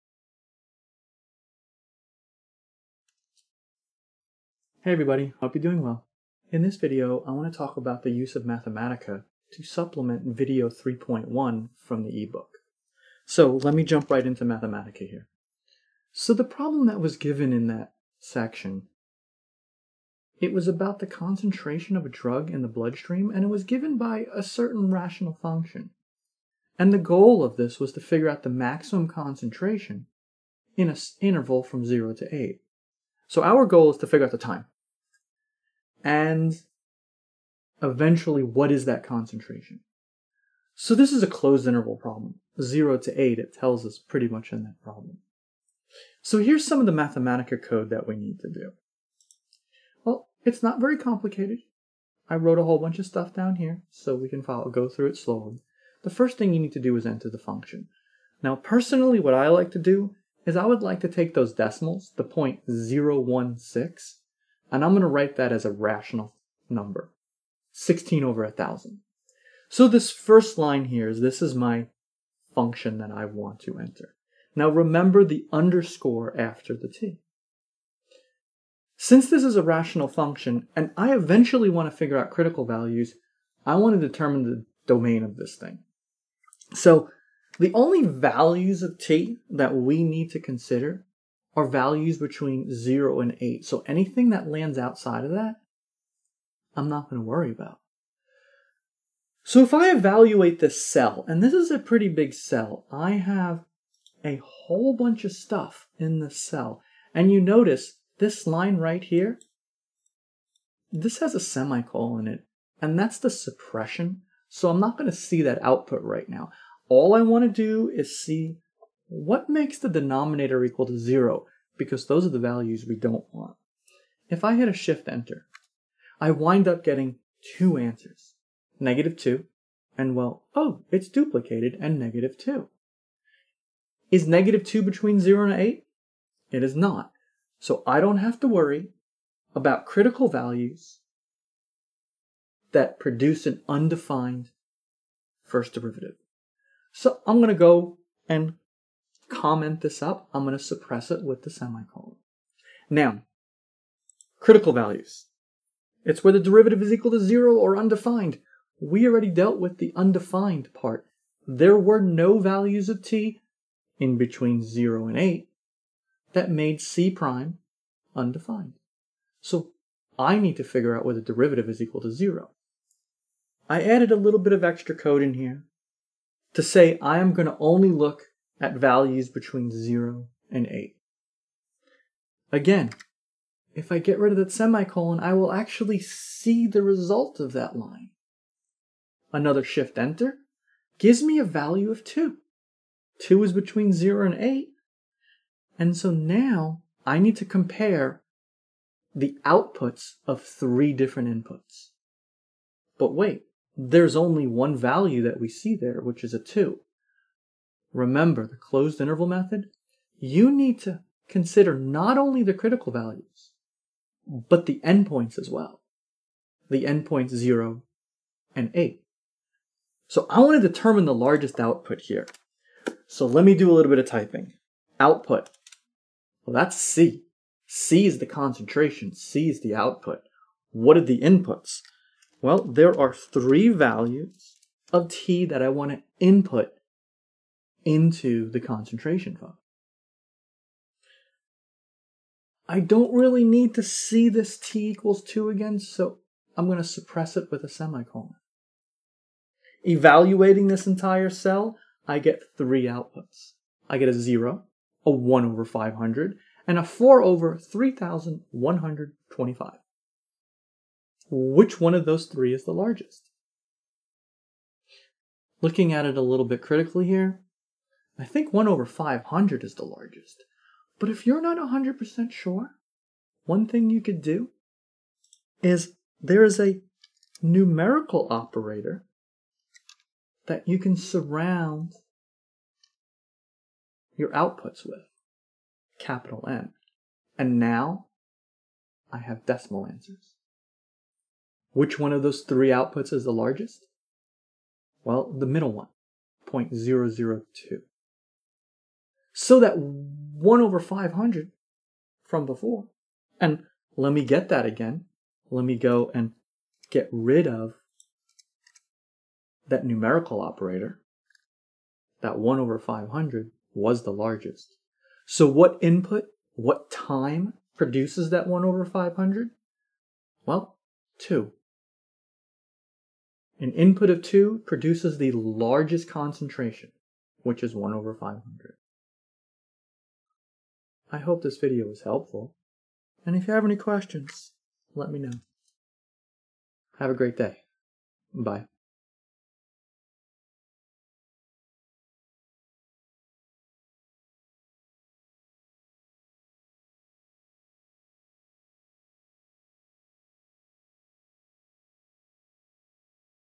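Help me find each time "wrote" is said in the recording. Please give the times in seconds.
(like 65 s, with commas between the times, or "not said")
52 s.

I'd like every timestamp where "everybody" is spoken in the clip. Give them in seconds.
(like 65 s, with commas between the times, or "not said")
4 s.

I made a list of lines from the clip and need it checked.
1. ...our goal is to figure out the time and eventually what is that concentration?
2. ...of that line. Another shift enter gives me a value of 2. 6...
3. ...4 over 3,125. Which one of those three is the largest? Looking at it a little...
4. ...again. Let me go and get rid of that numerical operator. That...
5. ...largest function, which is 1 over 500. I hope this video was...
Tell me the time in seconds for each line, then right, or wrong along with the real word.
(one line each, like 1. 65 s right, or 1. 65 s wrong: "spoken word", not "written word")
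1. 33 s right
2. 187 s wrong: "2", not "6"
3. 256 s right
4. 304 s right
5. 325 s wrong: "concentration", not "function".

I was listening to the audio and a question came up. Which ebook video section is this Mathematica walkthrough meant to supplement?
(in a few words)
3.1.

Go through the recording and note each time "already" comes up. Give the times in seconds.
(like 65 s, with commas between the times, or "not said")
159 s.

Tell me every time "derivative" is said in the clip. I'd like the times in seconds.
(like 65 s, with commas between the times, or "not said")
145 s, 156 s, 171 s.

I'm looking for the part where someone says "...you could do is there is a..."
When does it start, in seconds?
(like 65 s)
273 s.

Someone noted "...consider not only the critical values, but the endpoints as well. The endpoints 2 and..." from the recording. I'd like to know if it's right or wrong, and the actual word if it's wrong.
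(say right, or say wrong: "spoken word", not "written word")
wrong: "0", not "2".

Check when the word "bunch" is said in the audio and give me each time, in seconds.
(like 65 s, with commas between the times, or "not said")
52 s, 104 s.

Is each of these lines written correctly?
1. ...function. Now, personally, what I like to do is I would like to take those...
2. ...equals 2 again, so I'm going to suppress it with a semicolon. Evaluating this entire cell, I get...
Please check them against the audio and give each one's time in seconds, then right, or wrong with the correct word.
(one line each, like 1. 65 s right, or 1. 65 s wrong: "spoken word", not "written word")
1. 57 s right
2. 244 s right.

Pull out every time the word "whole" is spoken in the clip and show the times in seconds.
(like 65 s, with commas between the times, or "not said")
52 s, 104 s.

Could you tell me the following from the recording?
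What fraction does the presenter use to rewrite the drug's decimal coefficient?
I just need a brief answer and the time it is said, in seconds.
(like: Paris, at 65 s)
16/1000, at 67 s.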